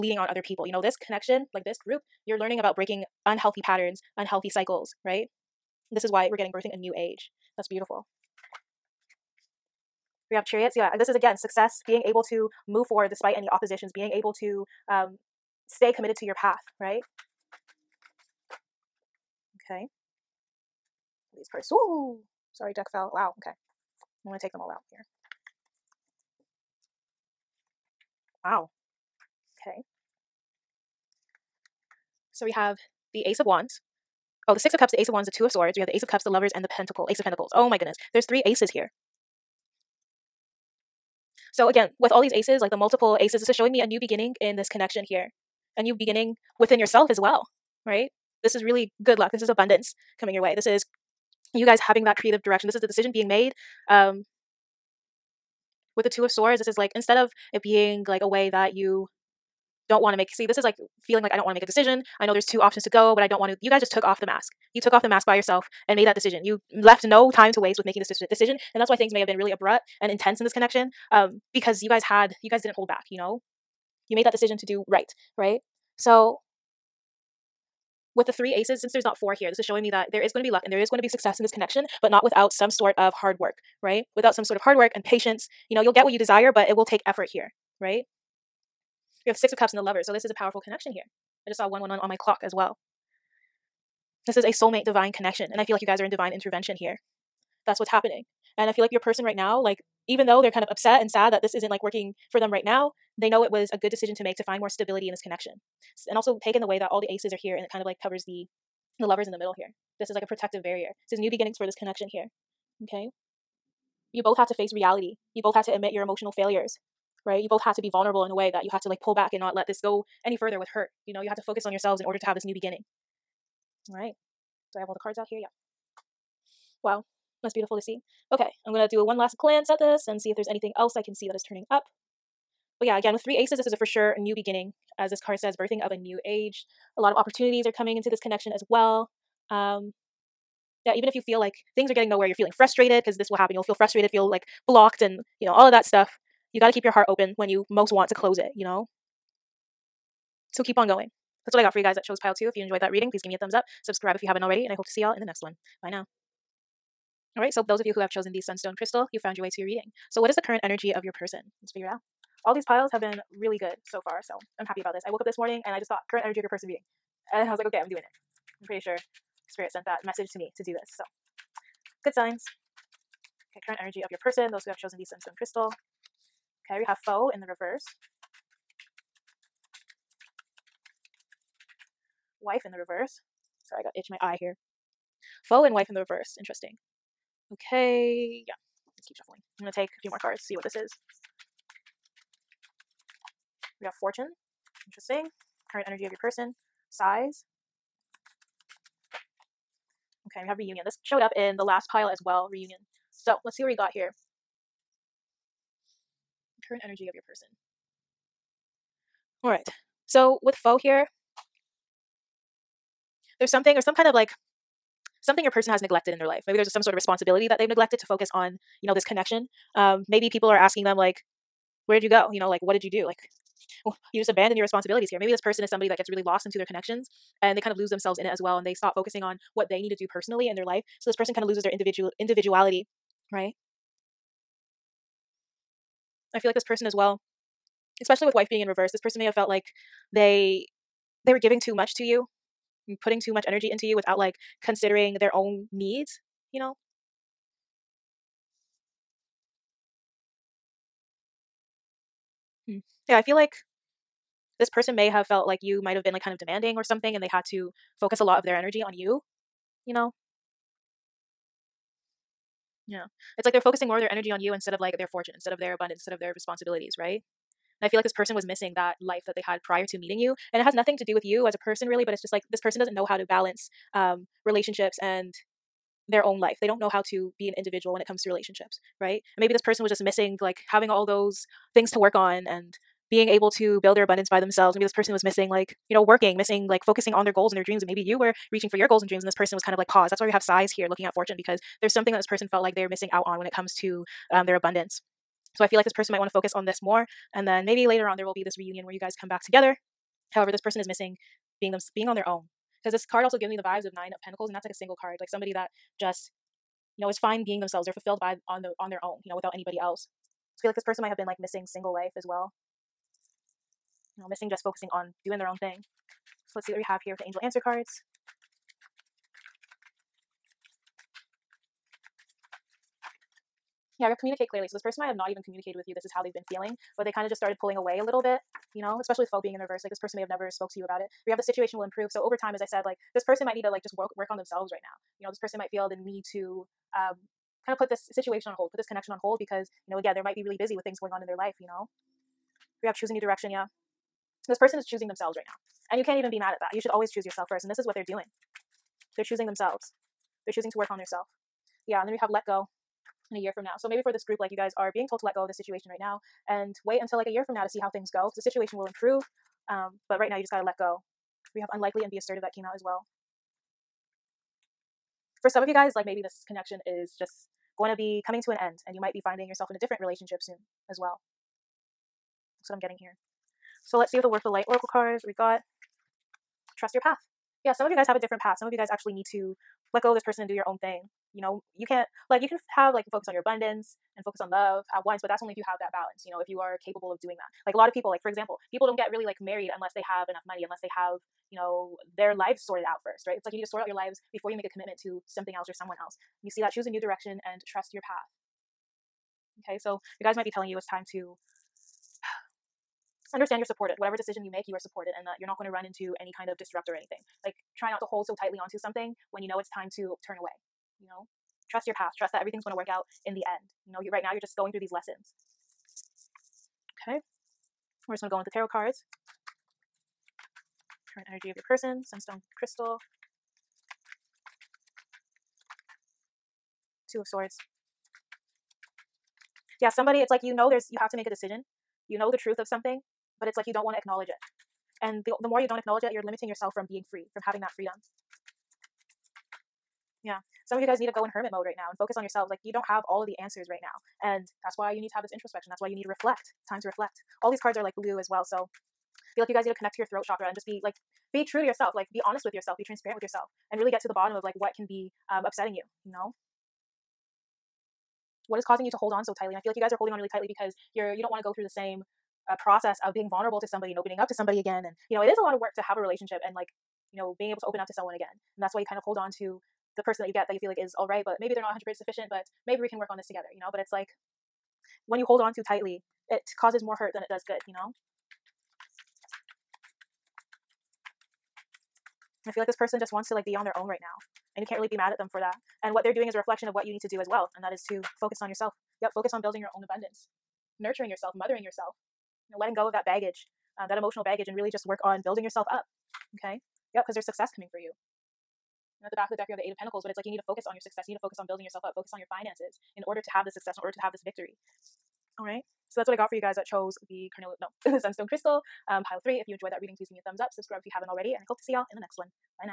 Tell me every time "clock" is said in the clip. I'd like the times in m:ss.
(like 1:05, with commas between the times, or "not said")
1:32.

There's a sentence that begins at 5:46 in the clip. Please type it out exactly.
You should always choose yourself first.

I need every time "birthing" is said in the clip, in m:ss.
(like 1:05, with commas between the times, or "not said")
0:06, 2:15.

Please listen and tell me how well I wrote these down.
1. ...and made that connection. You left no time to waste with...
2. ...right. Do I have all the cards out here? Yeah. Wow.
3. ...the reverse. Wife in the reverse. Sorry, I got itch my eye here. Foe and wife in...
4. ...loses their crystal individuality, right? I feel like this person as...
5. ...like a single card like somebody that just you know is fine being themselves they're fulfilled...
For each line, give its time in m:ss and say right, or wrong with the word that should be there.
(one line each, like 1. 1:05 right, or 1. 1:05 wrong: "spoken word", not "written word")
1. 1:05 wrong: "decision", not "connection"
2. 2:03 right
3. 2:57 right
4. 3:51 wrong: "individual", not "crystal"
5. 5:04 right.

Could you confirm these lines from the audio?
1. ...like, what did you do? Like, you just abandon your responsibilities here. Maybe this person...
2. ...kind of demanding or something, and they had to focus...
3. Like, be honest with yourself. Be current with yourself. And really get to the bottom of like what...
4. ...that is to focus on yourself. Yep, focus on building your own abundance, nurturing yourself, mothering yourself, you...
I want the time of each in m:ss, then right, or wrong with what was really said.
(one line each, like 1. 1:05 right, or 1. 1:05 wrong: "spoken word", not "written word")
1. 3:42 right
2. 4:16 right
3. 7:31 wrong: "transparent", not "current"
4. 8:07 right.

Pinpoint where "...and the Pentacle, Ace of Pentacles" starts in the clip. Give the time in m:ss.
0:36.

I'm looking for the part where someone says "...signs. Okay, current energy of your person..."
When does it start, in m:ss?
2:52.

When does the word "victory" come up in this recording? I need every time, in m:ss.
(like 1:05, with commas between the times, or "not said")
8:24.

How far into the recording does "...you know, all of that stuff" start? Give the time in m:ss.
2:25.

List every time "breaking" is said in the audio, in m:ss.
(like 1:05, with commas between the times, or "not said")
0:02.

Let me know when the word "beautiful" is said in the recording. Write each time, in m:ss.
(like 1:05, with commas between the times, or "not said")
0:07, 2:07.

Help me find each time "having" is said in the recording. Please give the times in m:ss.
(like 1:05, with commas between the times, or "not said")
0:51, 4:40, 7:17.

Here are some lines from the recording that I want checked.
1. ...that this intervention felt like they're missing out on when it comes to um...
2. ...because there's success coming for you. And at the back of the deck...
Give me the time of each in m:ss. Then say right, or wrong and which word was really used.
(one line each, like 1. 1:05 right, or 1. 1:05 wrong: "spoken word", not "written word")
1. 4:52 wrong: "person", not "intervention"
2. 8:17 right.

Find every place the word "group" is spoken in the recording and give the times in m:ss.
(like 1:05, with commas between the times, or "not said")
0:01, 5:54.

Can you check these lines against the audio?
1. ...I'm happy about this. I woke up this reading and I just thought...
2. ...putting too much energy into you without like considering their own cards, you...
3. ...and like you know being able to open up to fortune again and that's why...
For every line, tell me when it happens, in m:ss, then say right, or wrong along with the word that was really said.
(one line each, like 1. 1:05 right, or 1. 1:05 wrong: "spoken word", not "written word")
1. 2:44 wrong: "morning", not "reading"
2. 4:03 wrong: "needs", not "cards"
3. 7:46 wrong: "someone", not "fortune".